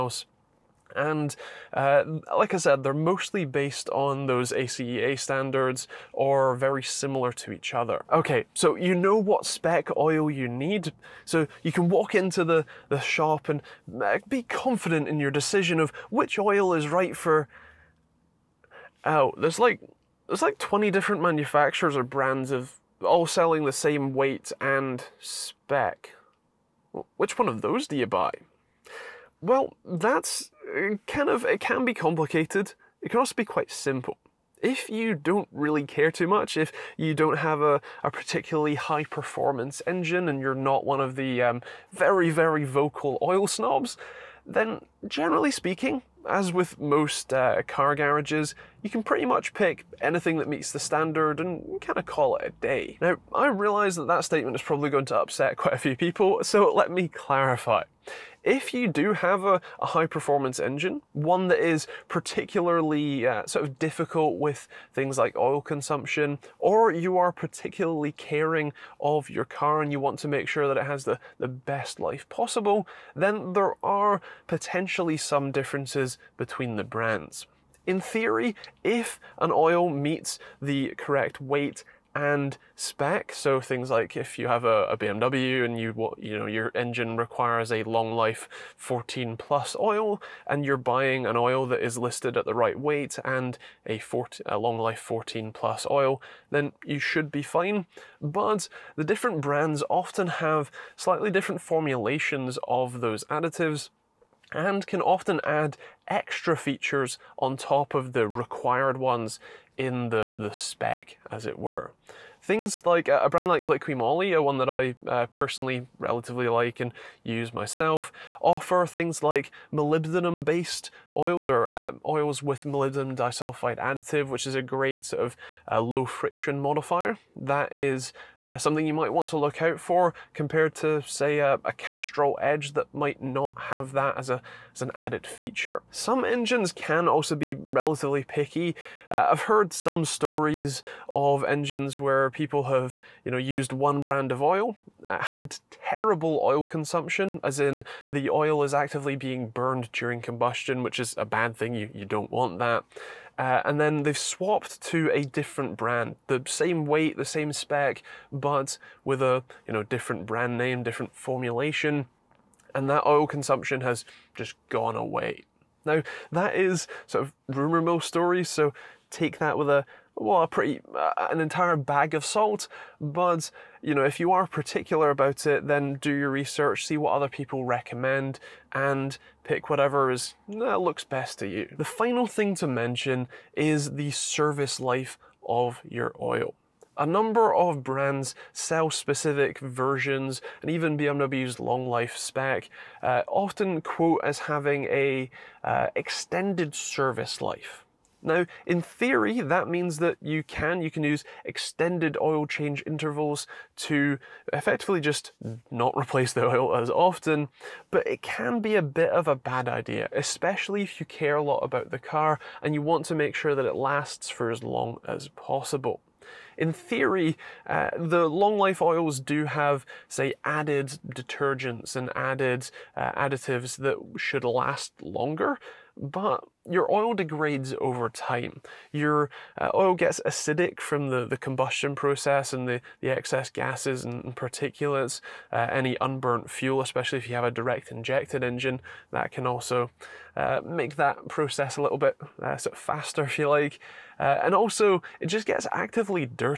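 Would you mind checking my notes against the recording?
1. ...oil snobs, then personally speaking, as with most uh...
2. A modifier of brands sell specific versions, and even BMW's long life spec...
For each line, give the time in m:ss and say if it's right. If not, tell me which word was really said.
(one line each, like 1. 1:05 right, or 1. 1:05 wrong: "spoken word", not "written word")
1. 0:43 wrong: "generally", not "personally"
2. 3:06 wrong: "number", not "modifier".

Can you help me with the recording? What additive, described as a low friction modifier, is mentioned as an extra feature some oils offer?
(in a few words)
Molybdenum disulfide.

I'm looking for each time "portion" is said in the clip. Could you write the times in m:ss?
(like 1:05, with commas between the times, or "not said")
not said.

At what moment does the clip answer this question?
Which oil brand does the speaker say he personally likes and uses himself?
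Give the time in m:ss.
1:53.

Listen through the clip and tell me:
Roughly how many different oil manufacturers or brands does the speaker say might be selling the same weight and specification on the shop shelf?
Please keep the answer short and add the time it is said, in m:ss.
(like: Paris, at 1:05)
20, at 0:20.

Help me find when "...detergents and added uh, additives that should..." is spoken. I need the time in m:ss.
3:41.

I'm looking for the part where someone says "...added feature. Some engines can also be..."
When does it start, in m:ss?
2:14.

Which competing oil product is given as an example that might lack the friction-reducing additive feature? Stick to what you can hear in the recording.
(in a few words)
Castrol Edge.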